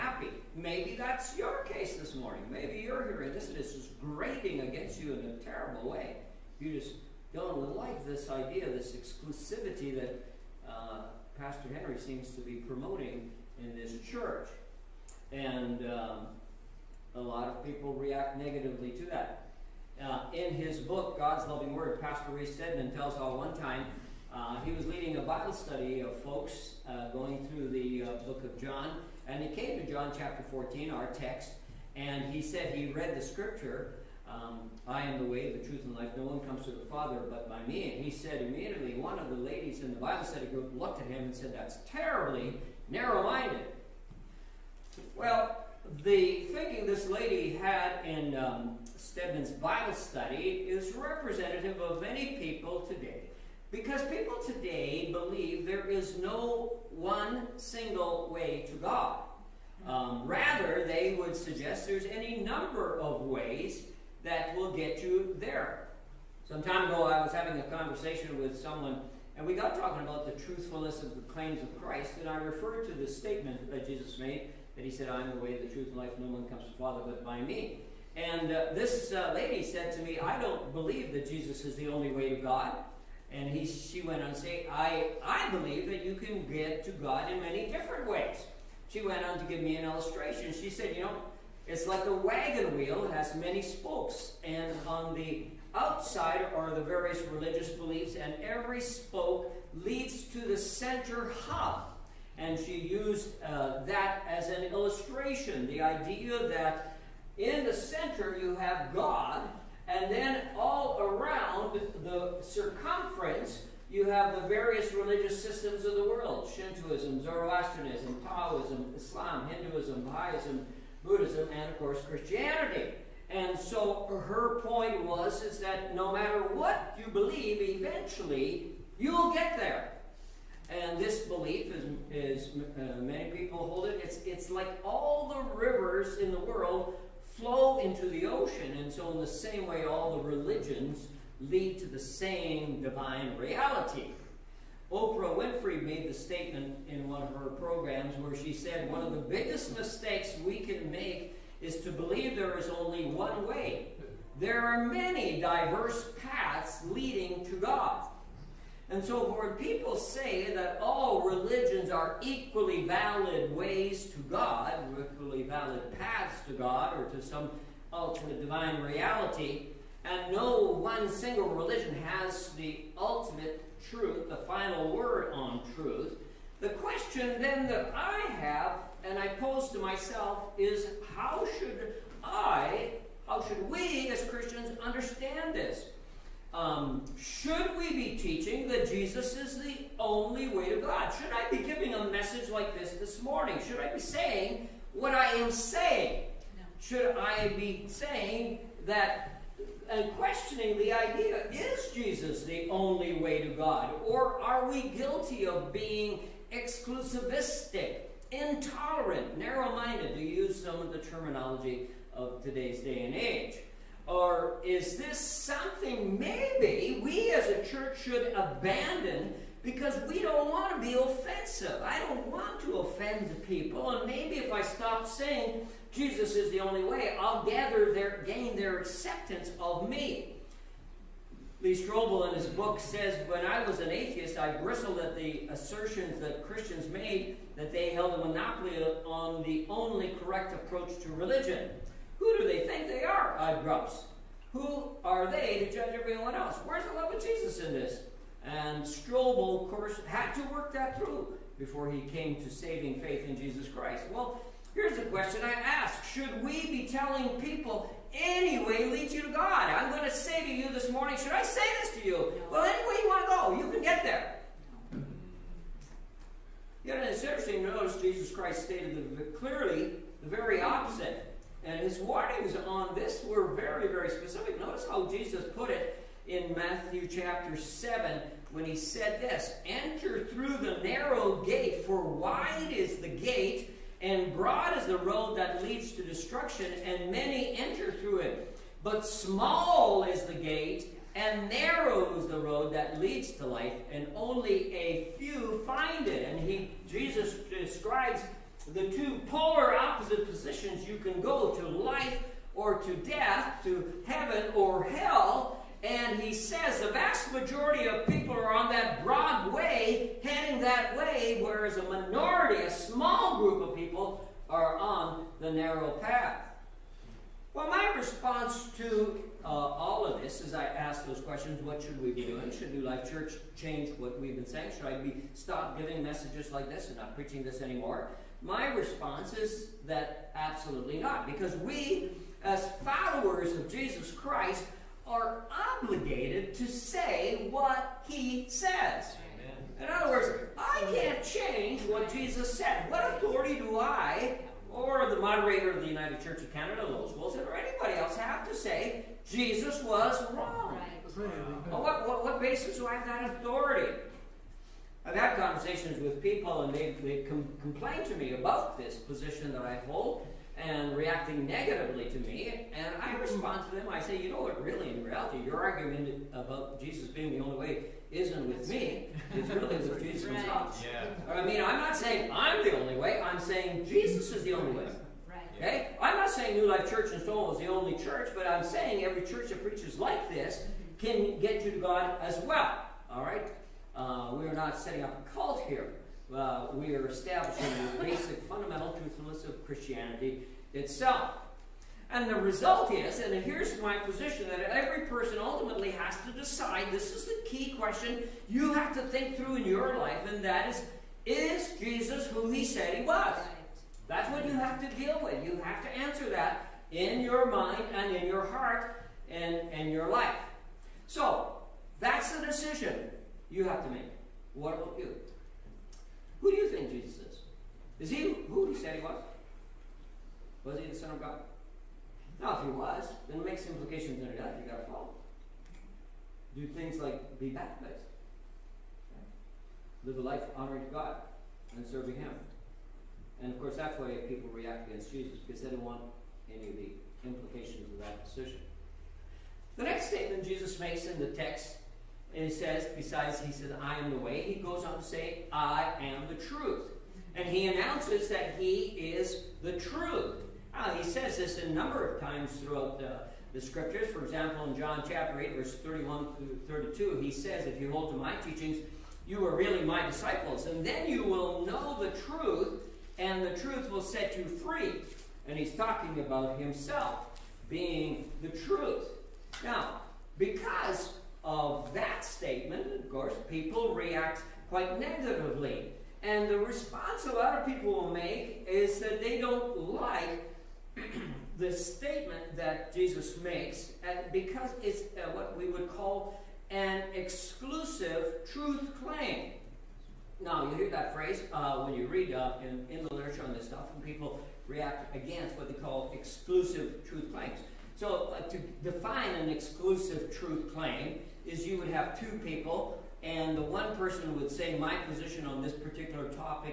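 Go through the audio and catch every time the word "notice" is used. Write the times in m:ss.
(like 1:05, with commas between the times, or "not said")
4:27, 4:34.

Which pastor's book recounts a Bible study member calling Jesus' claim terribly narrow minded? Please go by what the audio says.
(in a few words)
Reese Stedman.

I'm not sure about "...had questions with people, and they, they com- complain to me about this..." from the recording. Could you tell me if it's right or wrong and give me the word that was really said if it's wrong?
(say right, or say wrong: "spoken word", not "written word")
wrong: "conversations", not "questions".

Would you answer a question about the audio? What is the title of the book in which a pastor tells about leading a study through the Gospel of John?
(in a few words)
God's Loving Word.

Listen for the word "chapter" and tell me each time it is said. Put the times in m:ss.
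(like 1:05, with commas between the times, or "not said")
0:30, 4:37, 7:35.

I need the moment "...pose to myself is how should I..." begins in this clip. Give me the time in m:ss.
2:59.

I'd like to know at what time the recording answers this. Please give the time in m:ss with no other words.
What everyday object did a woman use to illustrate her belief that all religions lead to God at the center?
1:32.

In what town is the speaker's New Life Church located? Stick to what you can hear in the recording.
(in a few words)
Stonewall.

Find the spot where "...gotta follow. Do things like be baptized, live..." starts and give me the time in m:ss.
7:04.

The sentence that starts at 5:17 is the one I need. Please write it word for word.
Well, my response to uh, all of this is I ask those questions what should we be doing?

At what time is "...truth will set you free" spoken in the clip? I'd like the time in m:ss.
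7:43.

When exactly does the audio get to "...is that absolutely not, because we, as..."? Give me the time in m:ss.
5:29.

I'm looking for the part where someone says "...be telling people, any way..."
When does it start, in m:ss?
4:16.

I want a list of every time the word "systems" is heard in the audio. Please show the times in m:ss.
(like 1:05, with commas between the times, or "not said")
1:55.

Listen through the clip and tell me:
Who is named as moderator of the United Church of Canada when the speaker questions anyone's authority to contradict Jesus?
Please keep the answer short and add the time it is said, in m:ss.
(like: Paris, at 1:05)
Lois Wilson, at 5:46.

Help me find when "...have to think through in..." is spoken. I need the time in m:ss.
6:38.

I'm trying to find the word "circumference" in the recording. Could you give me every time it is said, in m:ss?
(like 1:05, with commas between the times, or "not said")
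1:52.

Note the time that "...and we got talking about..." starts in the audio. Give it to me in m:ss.
1:09.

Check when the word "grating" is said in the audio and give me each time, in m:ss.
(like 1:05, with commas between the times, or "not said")
0:03.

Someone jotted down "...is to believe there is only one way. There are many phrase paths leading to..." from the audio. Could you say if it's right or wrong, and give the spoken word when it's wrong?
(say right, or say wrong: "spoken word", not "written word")
wrong: "diverse", not "phrase".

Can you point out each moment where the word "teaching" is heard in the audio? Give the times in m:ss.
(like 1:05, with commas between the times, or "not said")
3:08, 7:38.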